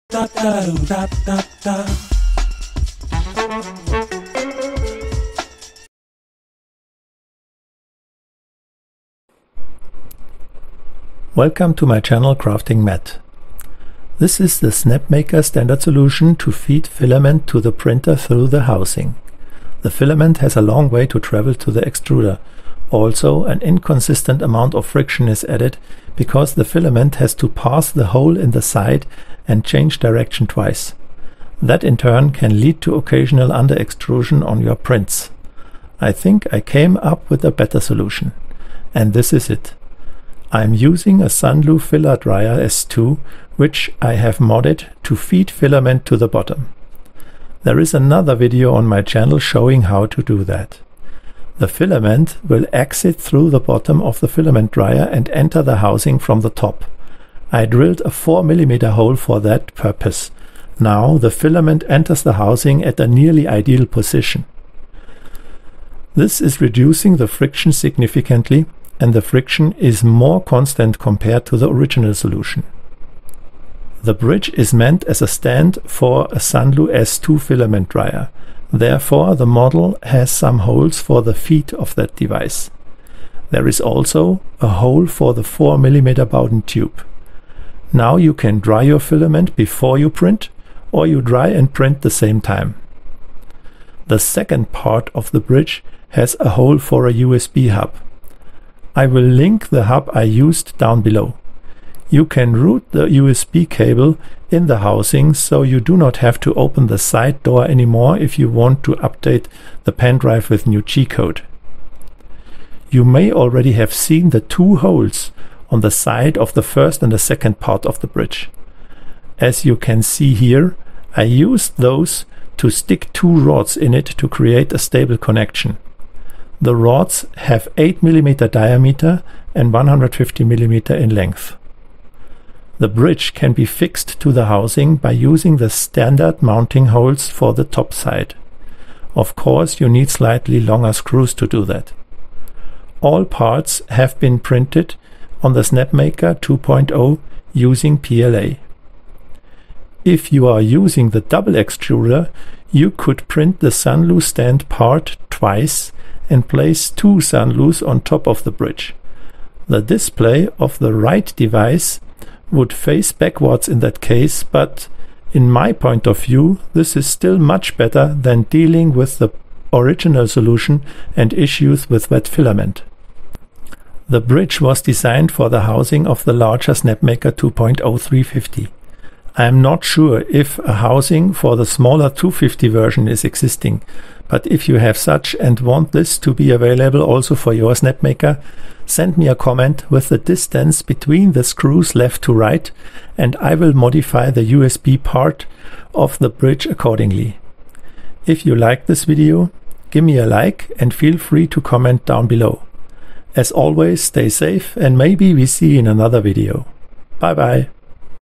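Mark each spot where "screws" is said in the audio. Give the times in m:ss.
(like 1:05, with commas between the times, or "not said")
2:20, 3:11.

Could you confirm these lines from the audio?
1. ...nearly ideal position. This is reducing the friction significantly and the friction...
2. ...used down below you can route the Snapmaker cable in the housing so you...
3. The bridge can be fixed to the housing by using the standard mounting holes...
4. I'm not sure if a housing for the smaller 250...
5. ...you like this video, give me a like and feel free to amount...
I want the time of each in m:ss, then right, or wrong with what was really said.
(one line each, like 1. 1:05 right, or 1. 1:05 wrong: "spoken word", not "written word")
1. 1:03 right
2. 1:40 wrong: "USB", not "Snapmaker"
3. 2:12 right
4. 2:59 right
5. 3:18 wrong: "comment", not "amount".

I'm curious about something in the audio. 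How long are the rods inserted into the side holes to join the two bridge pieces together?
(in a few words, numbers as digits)
150 mm.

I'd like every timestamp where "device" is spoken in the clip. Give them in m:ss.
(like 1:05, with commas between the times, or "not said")
1:22, 2:41.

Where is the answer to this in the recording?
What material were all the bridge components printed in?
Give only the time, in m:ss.
2:27.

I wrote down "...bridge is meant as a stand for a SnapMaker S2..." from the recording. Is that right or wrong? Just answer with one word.
wrong.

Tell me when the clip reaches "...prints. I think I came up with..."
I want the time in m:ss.
0:34.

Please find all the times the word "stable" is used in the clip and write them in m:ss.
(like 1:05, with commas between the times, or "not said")
2:04.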